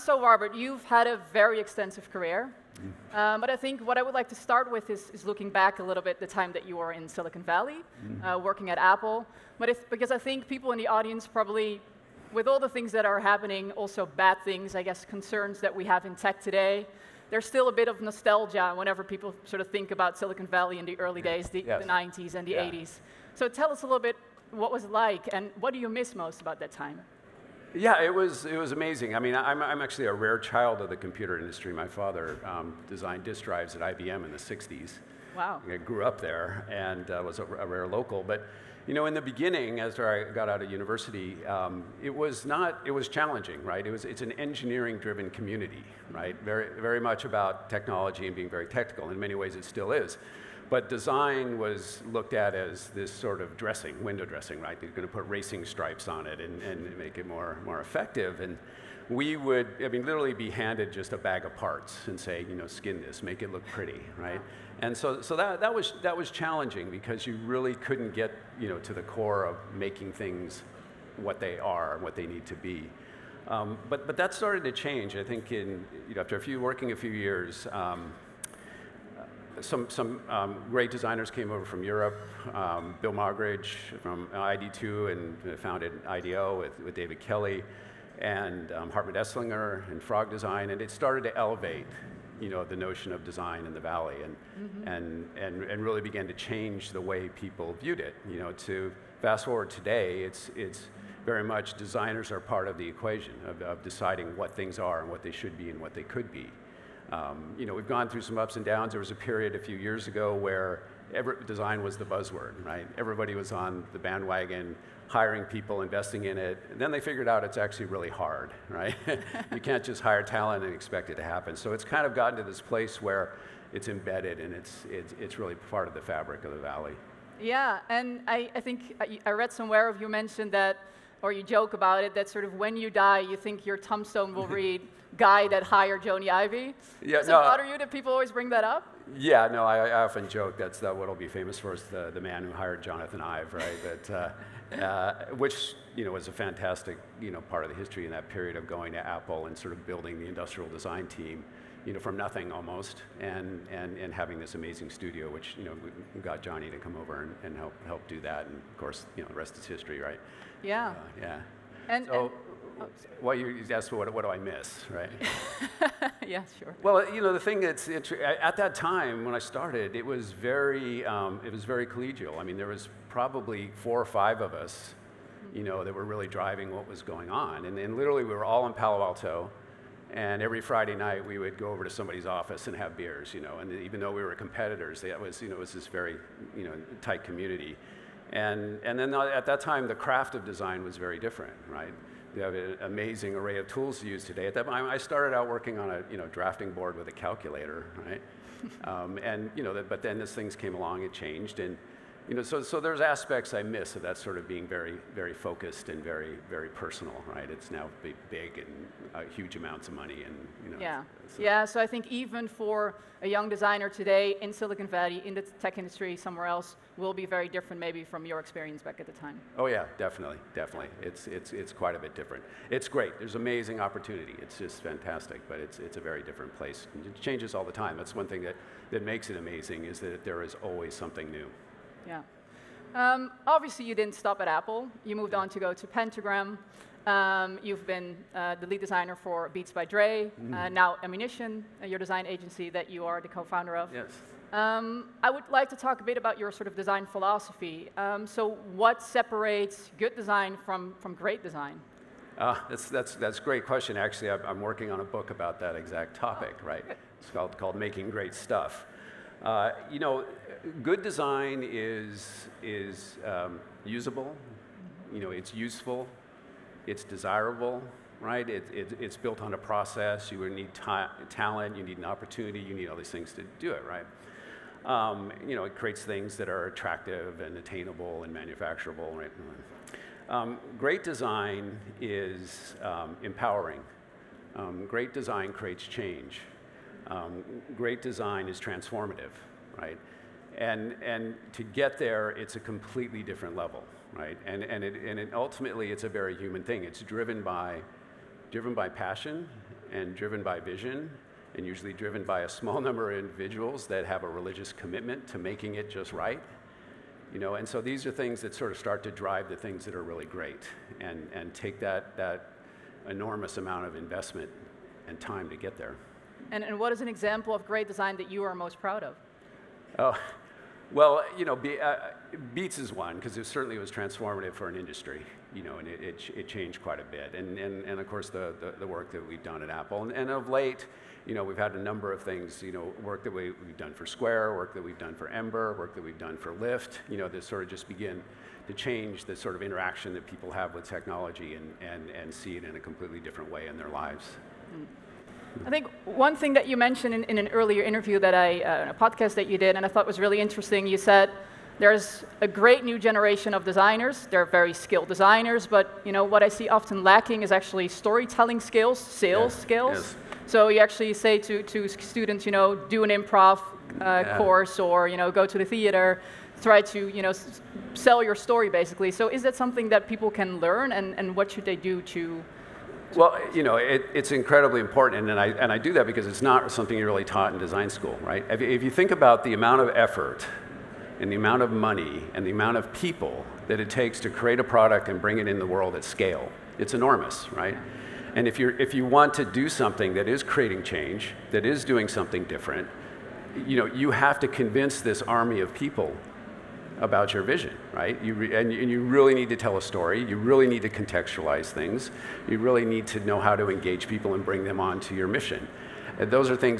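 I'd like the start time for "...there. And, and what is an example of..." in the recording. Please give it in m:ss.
5:15.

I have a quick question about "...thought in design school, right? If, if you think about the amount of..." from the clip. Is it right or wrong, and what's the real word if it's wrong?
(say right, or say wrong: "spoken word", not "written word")
wrong: "taught", not "thought".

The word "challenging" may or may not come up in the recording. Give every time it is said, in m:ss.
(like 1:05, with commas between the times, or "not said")
0:43, 1:06.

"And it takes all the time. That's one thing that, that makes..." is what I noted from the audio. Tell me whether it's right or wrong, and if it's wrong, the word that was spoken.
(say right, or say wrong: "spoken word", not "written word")
wrong: "changes", not "takes".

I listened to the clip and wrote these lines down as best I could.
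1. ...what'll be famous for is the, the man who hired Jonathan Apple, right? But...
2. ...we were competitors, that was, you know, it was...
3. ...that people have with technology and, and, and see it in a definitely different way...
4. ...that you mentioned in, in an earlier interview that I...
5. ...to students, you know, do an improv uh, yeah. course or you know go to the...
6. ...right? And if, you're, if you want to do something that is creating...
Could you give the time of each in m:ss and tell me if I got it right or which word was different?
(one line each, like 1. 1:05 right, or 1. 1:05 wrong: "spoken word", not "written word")
1. 2:20 wrong: "Ive", not "Apple"
2. 3:04 right
3. 5:40 wrong: "completely", not "definitely"
4. 5:46 right
5. 6:01 right
6. 6:27 right.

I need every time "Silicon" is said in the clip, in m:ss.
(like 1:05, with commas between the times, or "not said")
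0:07, 0:20, 3:34.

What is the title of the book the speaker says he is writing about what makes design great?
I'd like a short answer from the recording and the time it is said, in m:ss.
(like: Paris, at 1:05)
Making Great Stuff, at 4:17.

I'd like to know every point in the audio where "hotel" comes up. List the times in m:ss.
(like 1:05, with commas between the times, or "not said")
not said.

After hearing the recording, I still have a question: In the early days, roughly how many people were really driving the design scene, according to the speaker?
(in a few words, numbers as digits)
4 or 5.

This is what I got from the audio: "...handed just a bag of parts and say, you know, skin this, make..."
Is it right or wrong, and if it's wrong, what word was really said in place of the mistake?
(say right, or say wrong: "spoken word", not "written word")
right.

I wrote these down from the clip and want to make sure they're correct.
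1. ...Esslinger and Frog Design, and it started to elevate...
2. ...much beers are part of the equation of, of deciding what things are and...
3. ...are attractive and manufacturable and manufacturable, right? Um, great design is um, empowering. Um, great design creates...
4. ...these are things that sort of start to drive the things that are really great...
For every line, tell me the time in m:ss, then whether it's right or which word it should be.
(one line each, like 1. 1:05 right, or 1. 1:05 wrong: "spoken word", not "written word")
1. 1:29 right
2. 1:41 wrong: "designers", not "beers"
3. 4:36 wrong: "attainable", not "manufacturable"
4. 5:07 right.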